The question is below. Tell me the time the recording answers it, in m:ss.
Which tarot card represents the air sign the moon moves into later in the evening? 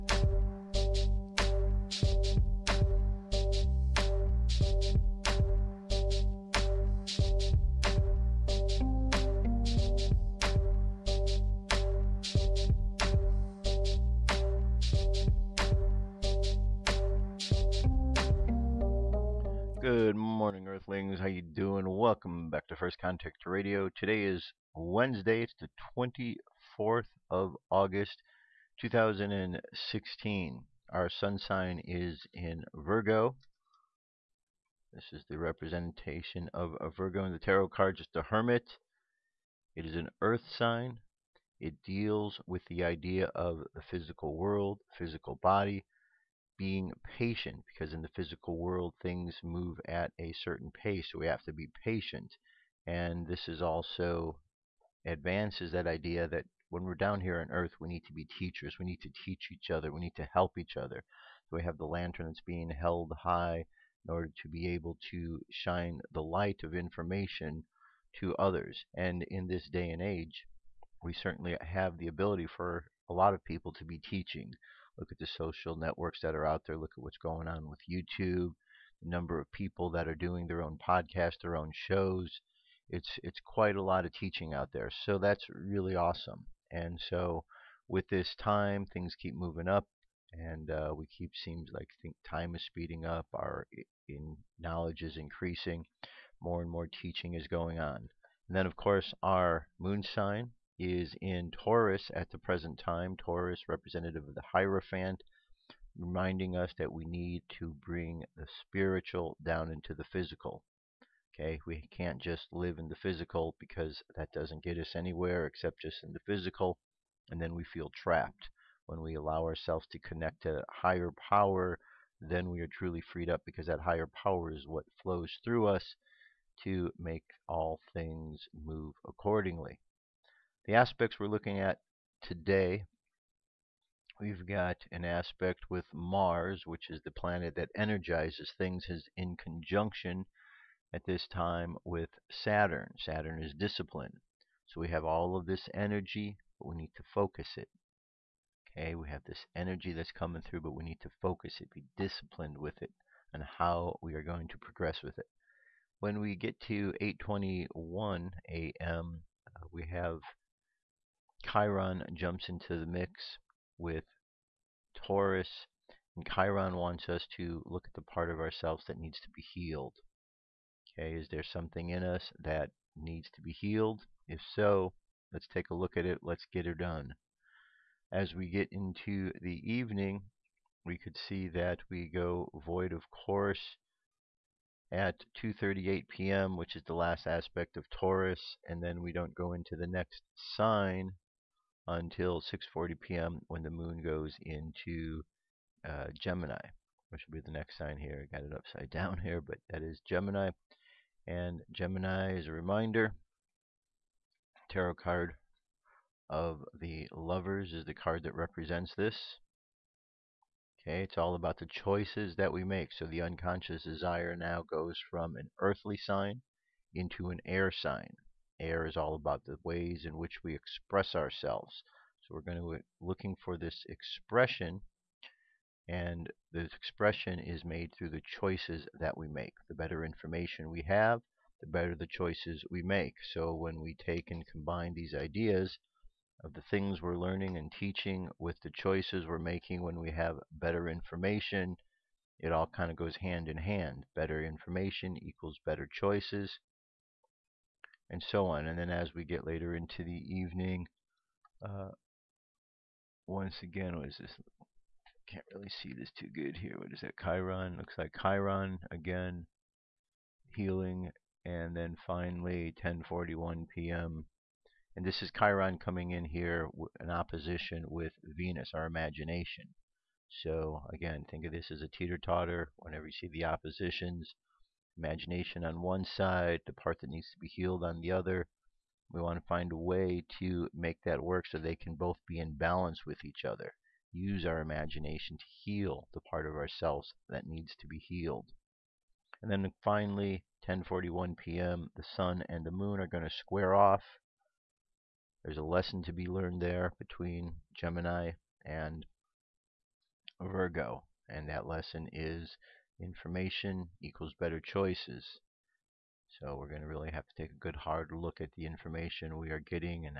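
3:26.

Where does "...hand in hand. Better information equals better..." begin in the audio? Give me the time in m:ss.
4:03.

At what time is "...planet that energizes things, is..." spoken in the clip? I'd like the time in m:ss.
2:17.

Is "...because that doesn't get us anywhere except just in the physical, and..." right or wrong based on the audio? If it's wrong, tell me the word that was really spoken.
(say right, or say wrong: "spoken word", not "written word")
right.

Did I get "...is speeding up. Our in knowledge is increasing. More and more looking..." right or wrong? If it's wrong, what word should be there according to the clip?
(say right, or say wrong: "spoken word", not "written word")
wrong: "teaching", not "looking".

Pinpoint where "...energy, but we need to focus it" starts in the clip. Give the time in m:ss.
2:25.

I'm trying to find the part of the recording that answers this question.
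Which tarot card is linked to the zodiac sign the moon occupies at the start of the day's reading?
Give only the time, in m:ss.
1:44.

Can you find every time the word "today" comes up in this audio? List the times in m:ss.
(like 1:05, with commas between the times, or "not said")
0:23, 2:12.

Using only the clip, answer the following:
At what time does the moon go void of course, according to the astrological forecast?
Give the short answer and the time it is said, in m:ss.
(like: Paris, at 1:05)
2:38 p.m., at 3:05.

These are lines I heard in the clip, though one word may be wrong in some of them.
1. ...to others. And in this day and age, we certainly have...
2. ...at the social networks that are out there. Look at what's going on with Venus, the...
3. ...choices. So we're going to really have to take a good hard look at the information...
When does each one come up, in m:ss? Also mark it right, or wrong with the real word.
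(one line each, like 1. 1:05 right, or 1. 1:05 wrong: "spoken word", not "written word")
1. 1:08 right
2. 1:15 wrong: "YouTube", not "Venus"
3. 5:04 right.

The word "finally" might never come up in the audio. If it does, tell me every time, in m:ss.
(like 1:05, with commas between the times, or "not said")
4:22, 4:49.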